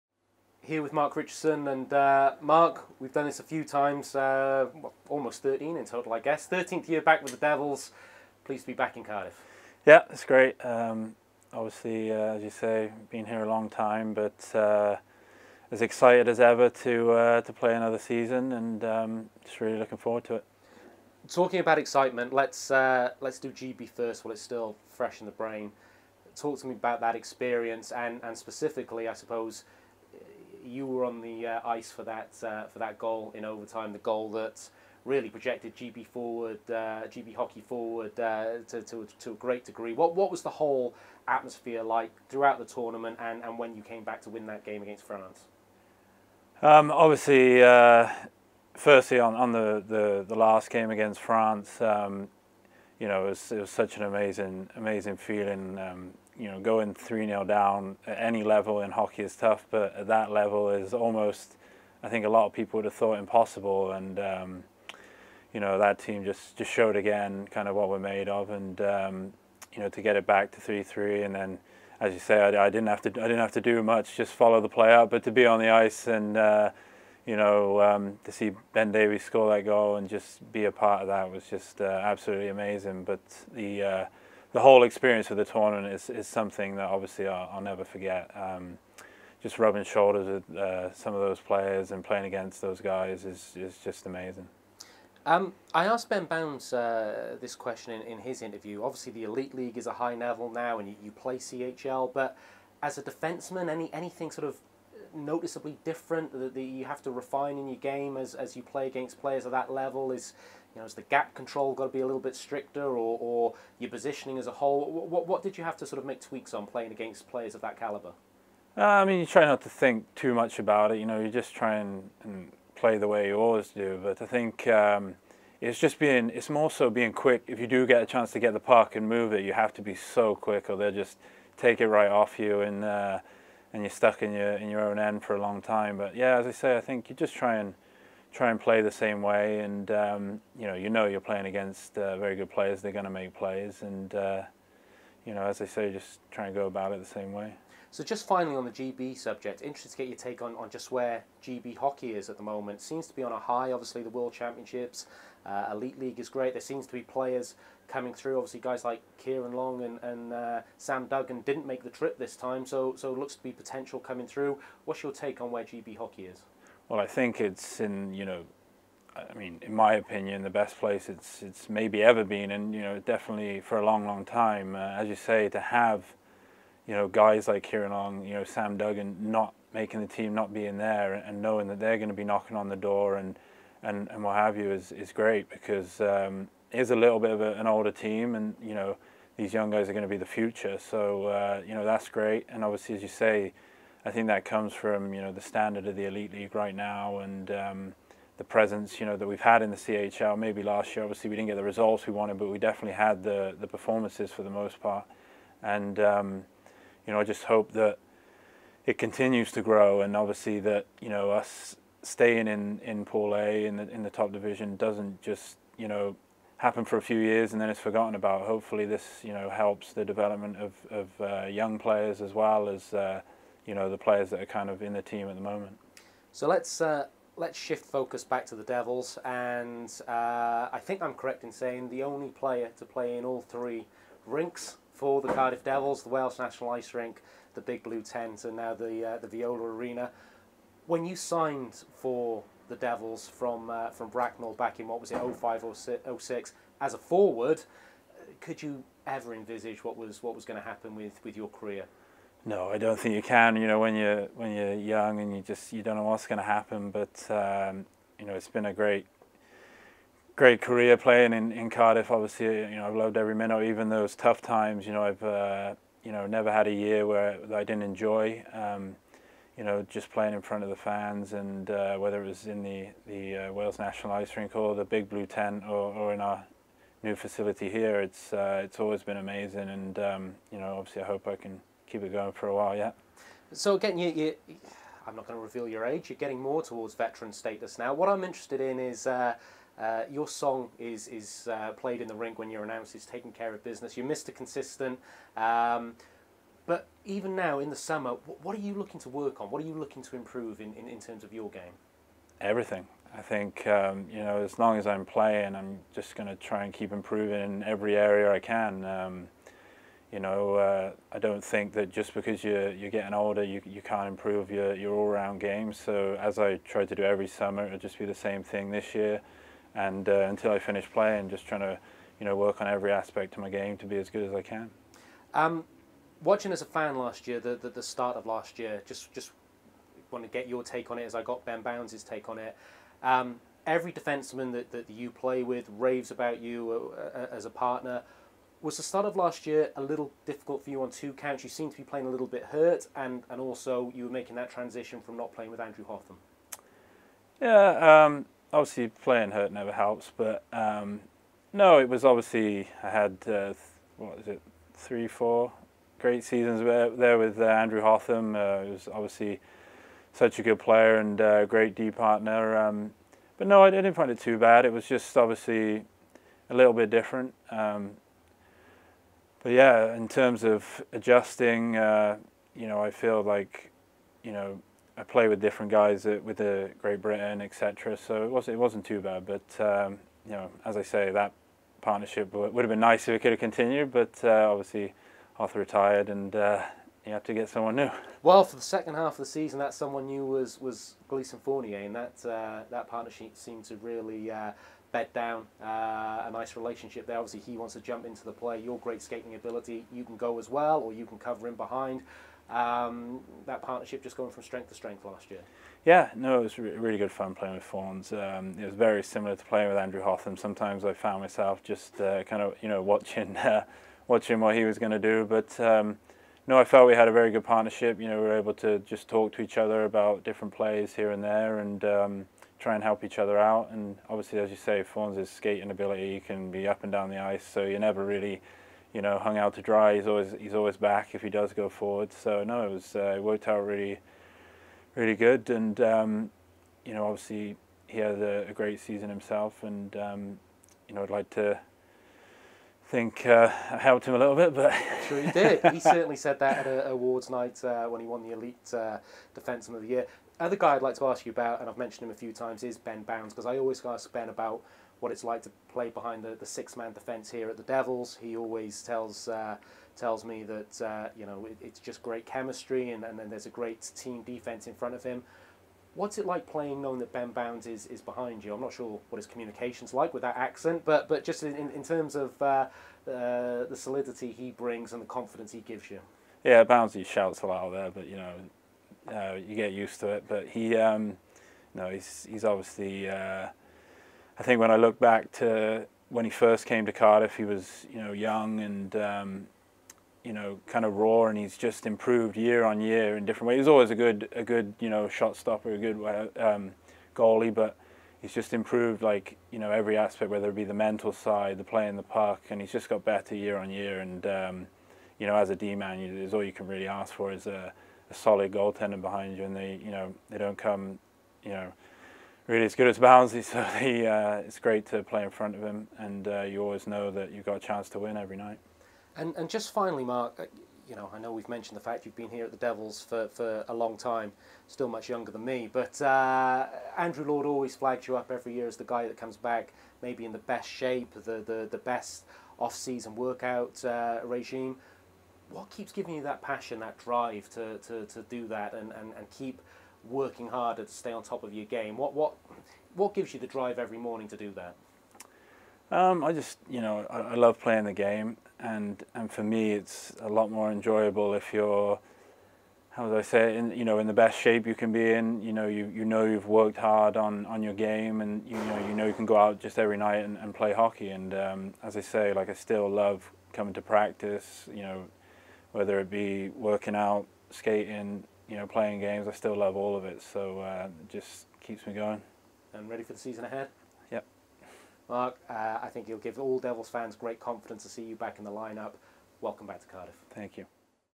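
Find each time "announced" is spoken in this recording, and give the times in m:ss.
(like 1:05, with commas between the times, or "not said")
4:52.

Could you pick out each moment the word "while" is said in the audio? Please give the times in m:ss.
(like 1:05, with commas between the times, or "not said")
0:24, 4:42.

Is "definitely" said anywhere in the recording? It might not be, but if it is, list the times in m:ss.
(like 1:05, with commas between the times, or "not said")
2:52, 3:22.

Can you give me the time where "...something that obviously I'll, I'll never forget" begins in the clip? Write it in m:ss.
1:26.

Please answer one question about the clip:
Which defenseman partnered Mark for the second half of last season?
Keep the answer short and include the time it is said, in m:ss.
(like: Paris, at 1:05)
Gleason Fournier, at 6:31.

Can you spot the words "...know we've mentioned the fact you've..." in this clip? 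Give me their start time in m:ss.
8:41.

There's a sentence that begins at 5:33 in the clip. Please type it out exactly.
Um, every defenseman that, that you play with raves about you uh, uh, as a partner.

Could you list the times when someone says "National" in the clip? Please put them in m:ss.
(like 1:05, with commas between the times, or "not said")
3:56, 4:33.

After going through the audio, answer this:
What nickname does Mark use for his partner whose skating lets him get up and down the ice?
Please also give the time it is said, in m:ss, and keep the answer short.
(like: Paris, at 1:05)
Fawns, at 6:47.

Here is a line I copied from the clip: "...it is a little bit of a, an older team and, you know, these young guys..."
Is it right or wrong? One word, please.
right.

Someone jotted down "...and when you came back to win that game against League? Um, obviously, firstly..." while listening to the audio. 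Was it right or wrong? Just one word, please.
wrong.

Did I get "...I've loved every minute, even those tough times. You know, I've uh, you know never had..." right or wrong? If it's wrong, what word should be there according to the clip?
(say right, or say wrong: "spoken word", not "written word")
right.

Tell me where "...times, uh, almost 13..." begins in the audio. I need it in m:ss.
0:03.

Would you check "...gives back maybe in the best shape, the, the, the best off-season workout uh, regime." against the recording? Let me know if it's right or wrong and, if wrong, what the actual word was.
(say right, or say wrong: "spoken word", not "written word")
wrong: "comes", not "gives".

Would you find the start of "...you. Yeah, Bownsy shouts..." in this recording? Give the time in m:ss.
7:55.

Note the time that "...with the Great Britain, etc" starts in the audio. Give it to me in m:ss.
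6:16.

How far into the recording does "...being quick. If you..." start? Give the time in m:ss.
2:06.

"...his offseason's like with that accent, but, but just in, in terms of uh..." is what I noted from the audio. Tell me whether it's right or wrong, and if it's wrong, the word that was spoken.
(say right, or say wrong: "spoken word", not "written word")
wrong: "communication", not "offseason".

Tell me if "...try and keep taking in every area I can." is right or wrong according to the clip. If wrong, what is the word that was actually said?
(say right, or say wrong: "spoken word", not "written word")
wrong: "improving", not "taking".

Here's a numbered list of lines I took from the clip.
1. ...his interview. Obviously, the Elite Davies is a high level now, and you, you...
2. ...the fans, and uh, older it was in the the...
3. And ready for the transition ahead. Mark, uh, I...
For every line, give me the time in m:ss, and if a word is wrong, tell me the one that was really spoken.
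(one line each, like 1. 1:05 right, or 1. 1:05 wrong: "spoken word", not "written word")
1. 1:38 wrong: "League", not "Davies"
2. 4:30 wrong: "whether", not "older"
3. 9:32 wrong: "season", not "transition".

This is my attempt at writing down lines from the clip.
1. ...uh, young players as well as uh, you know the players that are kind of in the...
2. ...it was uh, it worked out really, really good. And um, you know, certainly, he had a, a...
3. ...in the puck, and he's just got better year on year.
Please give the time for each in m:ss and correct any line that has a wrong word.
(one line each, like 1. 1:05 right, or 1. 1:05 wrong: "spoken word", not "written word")
1. 3:41 right
2. 7:12 wrong: "obviously", not "certainly"
3. 8:21 right.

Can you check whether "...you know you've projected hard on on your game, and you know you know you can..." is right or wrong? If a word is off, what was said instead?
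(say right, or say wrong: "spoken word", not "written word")
wrong: "worked", not "projected".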